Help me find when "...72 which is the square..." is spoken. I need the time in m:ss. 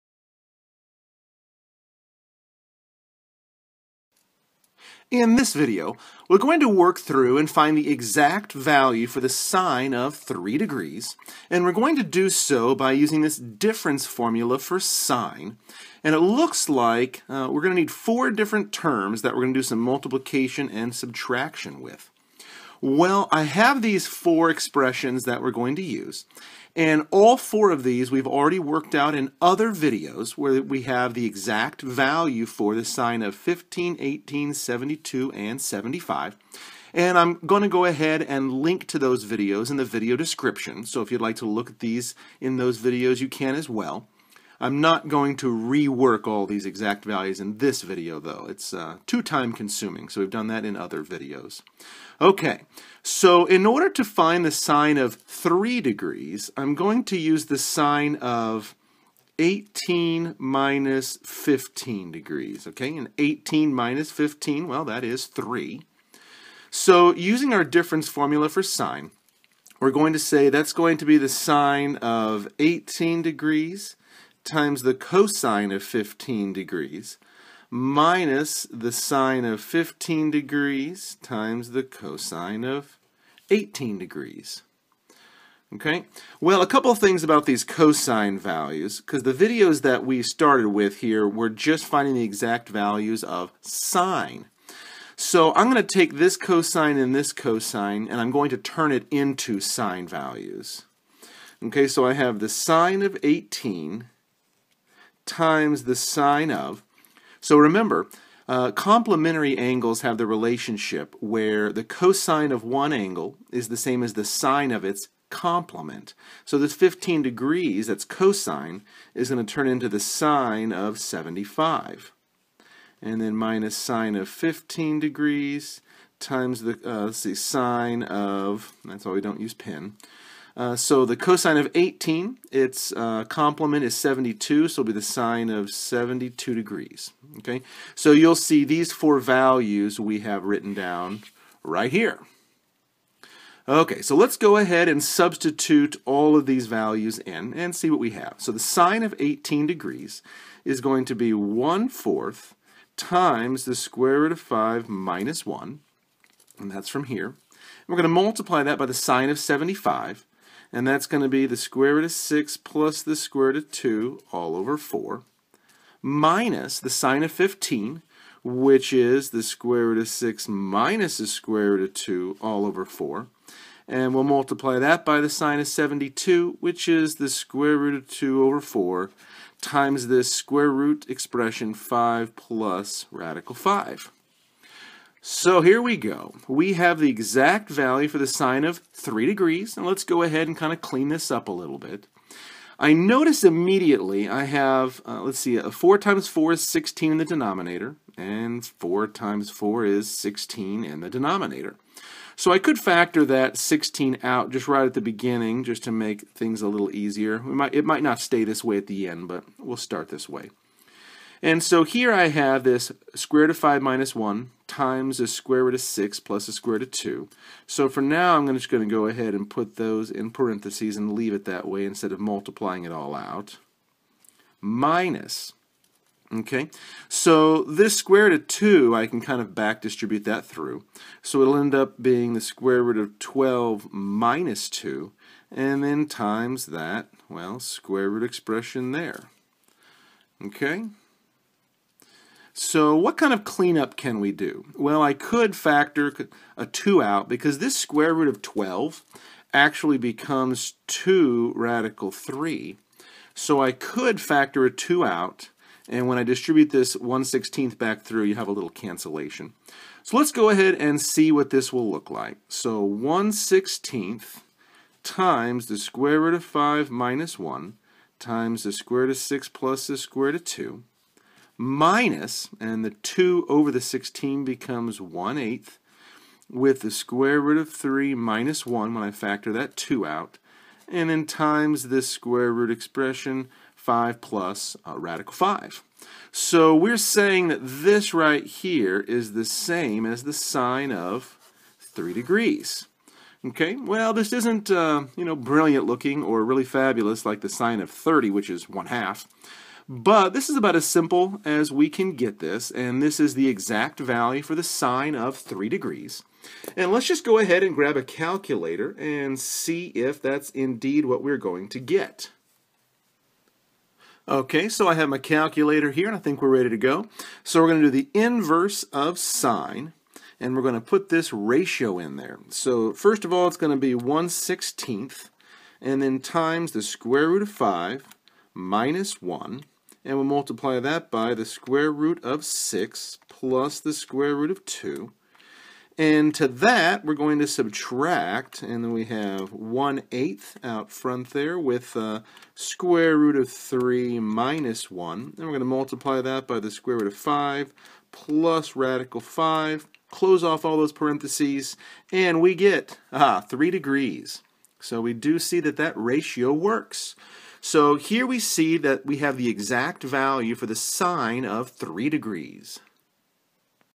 2:55.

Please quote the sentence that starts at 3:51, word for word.
So it'll end up being the square root of 12 minus 2, and then times that, well, square root expression there.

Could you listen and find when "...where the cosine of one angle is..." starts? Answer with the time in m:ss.
1:51.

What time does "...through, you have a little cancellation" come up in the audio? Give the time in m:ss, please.
4:18.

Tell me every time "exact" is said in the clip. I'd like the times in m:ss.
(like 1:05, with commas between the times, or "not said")
0:07, 0:31, 0:46, 1:32, 3:07, 5:03, 5:59.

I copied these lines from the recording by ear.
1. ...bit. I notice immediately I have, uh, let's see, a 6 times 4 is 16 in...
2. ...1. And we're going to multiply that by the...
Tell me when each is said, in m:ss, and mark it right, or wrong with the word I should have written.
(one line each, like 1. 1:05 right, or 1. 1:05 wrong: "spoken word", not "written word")
1. 3:11 wrong: "4", not "6"
2. 5:44 right.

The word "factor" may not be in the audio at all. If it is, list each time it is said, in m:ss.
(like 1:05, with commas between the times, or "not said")
3:22, 4:05, 4:14, 4:39.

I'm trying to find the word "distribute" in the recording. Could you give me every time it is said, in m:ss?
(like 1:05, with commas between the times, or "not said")
3:49, 4:16.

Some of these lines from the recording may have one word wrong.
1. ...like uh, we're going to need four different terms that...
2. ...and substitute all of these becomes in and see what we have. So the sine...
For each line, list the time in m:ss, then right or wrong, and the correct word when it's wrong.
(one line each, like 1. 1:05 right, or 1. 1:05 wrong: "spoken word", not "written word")
1. 0:16 right
2. 2:24 wrong: "values", not "becomes".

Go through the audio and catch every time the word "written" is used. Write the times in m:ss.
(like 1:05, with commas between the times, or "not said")
2:20.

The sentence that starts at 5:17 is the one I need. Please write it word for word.
So we're going to do the inverse of sine, and we're going to put this ratio in there.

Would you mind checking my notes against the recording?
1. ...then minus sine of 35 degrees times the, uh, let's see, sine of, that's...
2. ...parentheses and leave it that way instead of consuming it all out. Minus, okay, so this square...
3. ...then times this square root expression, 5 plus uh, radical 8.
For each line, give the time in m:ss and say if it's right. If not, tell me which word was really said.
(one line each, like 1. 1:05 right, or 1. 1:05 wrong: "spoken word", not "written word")
1. 2:03 wrong: "15", not "35"
2. 3:40 wrong: "multiplying", not "consuming"
3. 4:41 wrong: "5", not "8".